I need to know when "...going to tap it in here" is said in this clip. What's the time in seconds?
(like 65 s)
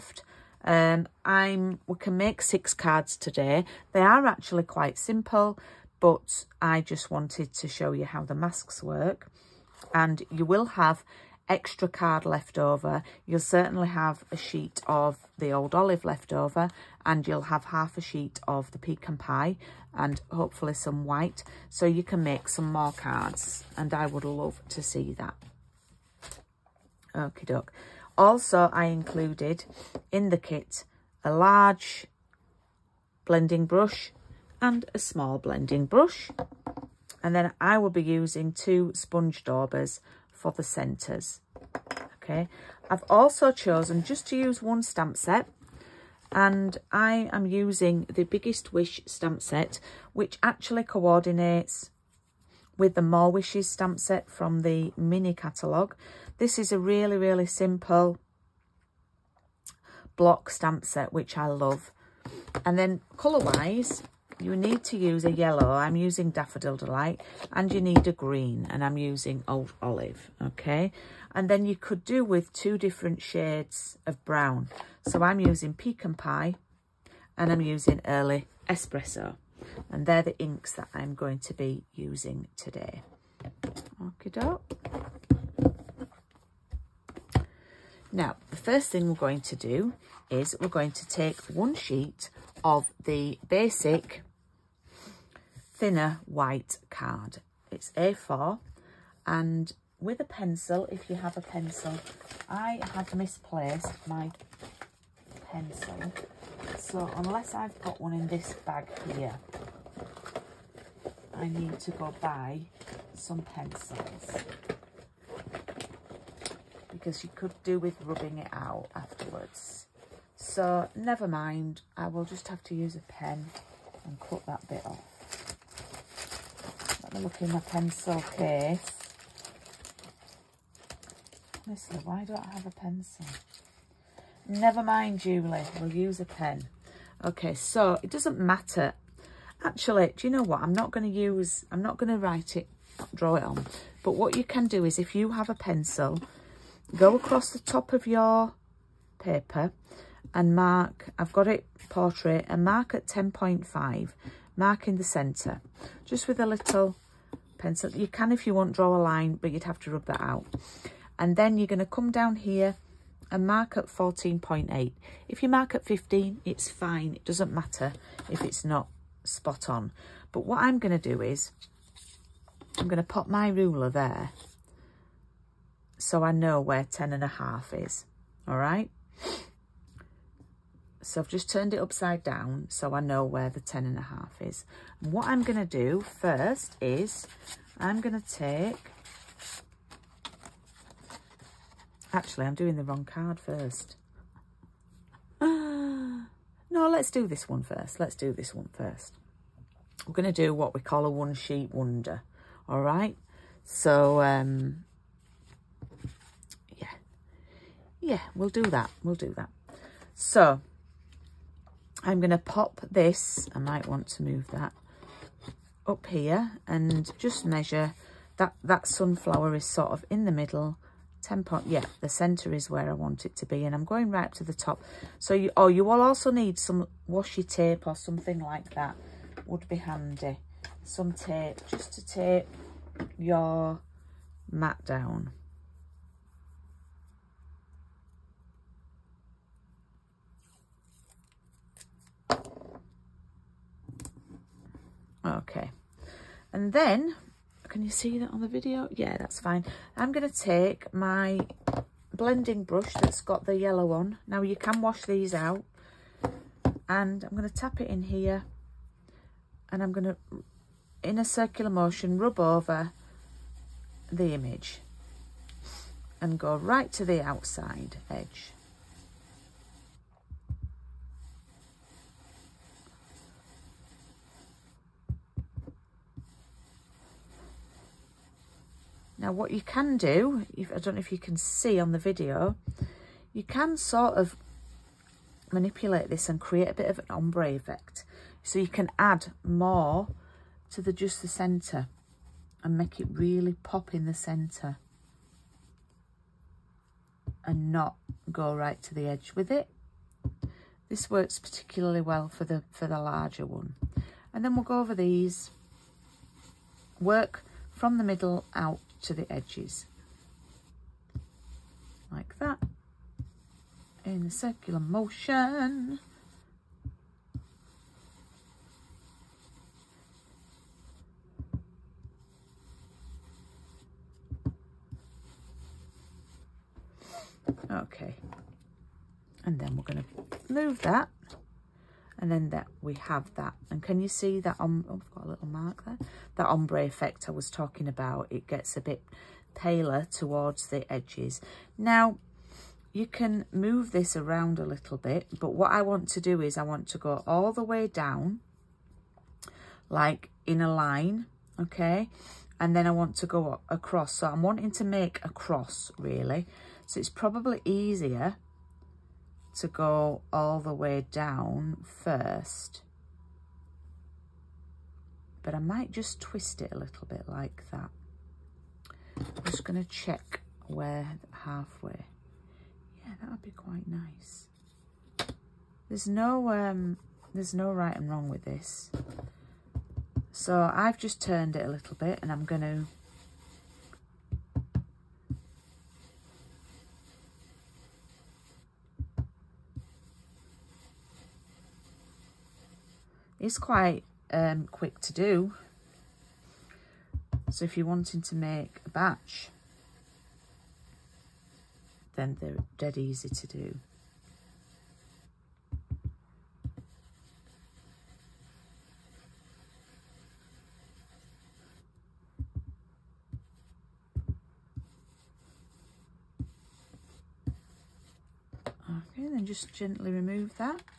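257 s.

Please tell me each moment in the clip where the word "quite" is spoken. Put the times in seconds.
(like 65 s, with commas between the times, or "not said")
4 s, 373 s, 393 s.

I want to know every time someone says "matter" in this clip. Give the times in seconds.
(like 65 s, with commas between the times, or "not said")
138 s, 167 s.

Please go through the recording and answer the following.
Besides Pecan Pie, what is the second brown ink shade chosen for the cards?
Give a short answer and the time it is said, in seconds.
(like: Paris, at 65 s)
Early Espresso, at 78 s.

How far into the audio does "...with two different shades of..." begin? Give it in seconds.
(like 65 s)
72 s.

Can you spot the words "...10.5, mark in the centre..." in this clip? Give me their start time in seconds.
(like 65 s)
153 s.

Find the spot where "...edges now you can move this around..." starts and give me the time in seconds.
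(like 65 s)
340 s.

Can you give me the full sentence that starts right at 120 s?
So never mind, I will just have to use a pen and cut that bit off.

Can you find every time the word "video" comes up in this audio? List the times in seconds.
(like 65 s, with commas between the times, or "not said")
248 s, 281 s.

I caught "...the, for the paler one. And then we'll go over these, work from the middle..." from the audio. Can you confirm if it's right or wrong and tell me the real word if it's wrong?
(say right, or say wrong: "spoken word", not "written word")
wrong: "larger", not "paler".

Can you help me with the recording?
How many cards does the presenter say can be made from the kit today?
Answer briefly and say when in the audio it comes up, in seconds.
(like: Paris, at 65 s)
6, at 2 s.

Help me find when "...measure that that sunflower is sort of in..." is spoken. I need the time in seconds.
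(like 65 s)
217 s.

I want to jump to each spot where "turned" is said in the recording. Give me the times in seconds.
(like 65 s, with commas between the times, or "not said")
181 s, 381 s.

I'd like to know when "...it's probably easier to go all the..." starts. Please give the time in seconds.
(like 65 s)
356 s.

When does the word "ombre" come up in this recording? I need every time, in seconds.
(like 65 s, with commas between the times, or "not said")
287 s, 336 s.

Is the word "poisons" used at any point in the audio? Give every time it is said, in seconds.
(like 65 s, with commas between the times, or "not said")
not said.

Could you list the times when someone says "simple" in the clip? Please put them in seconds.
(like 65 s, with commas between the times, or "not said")
4 s, 57 s.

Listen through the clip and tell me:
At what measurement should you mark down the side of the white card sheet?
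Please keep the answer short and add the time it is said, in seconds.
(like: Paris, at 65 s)
14.8, at 163 s.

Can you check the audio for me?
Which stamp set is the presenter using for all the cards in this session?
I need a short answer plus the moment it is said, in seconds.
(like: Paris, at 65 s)
Biggest Wish, at 48 s.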